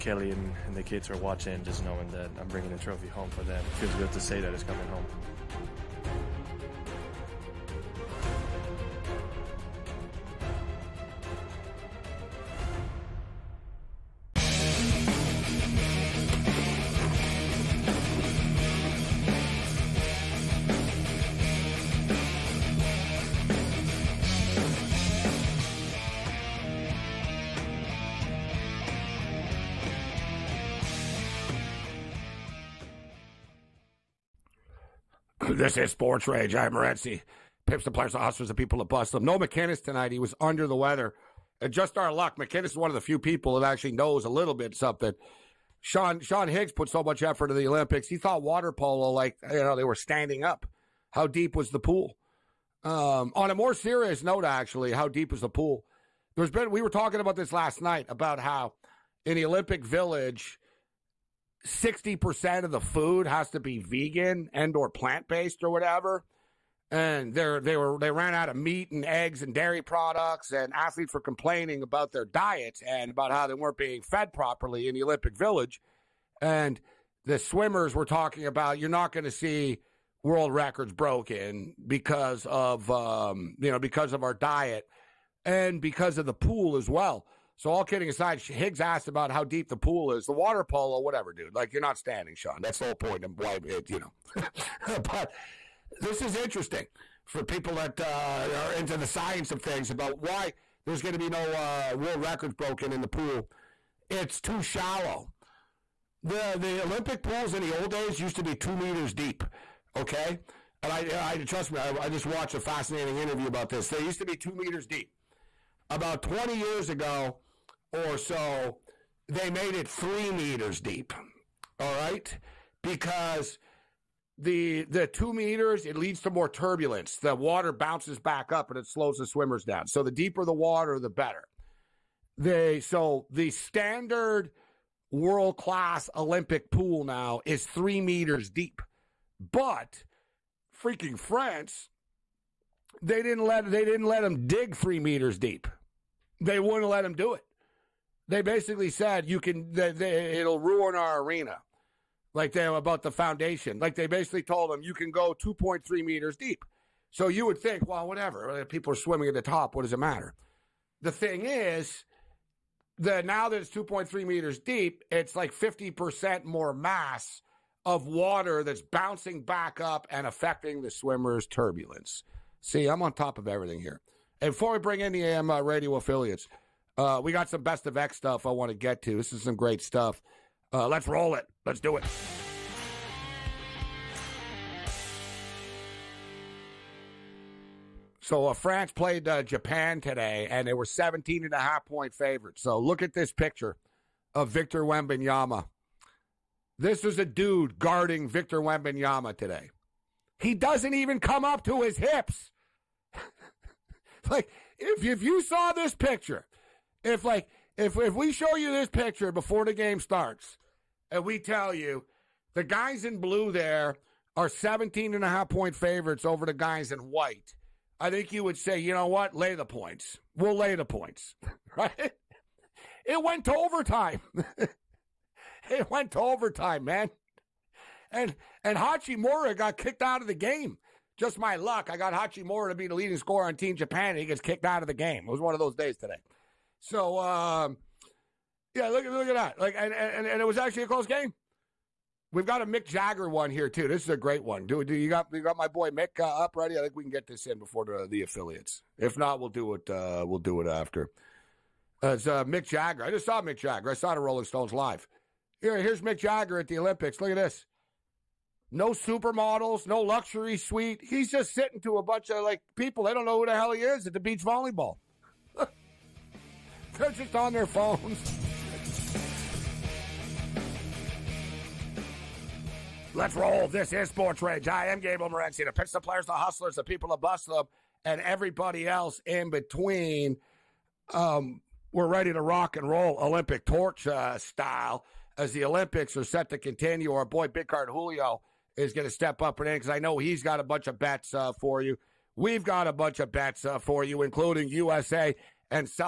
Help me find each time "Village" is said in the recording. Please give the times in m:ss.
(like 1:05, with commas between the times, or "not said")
0:59, 1:15.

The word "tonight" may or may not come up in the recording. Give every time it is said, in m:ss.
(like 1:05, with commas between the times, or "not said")
0:39.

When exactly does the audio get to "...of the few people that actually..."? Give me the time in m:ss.
0:42.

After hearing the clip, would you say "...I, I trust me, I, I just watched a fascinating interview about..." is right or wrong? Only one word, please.
right.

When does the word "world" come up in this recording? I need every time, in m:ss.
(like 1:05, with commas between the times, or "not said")
1:20, 1:41, 2:15.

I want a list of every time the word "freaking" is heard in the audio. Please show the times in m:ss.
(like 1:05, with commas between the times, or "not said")
2:20.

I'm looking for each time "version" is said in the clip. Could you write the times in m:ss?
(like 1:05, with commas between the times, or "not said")
not said.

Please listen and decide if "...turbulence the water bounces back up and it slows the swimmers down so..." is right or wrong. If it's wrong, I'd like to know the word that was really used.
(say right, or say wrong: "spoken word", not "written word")
right.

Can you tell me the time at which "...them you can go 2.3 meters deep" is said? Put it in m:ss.
2:34.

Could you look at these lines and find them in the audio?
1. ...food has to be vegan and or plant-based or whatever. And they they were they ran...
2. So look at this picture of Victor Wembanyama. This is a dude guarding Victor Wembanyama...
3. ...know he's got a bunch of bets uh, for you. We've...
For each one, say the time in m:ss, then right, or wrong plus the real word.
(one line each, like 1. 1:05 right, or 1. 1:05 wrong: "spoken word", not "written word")
1. 1:02 right
2. 3:12 right
3. 4:49 right.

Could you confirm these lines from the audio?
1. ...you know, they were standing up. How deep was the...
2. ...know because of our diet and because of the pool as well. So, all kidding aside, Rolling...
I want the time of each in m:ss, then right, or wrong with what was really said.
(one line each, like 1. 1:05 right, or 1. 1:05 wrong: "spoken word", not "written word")
1. 0:49 right
2. 1:23 wrong: "Higgs", not "Rolling".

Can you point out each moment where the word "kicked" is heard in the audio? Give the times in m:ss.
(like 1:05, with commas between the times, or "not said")
3:49, 3:54.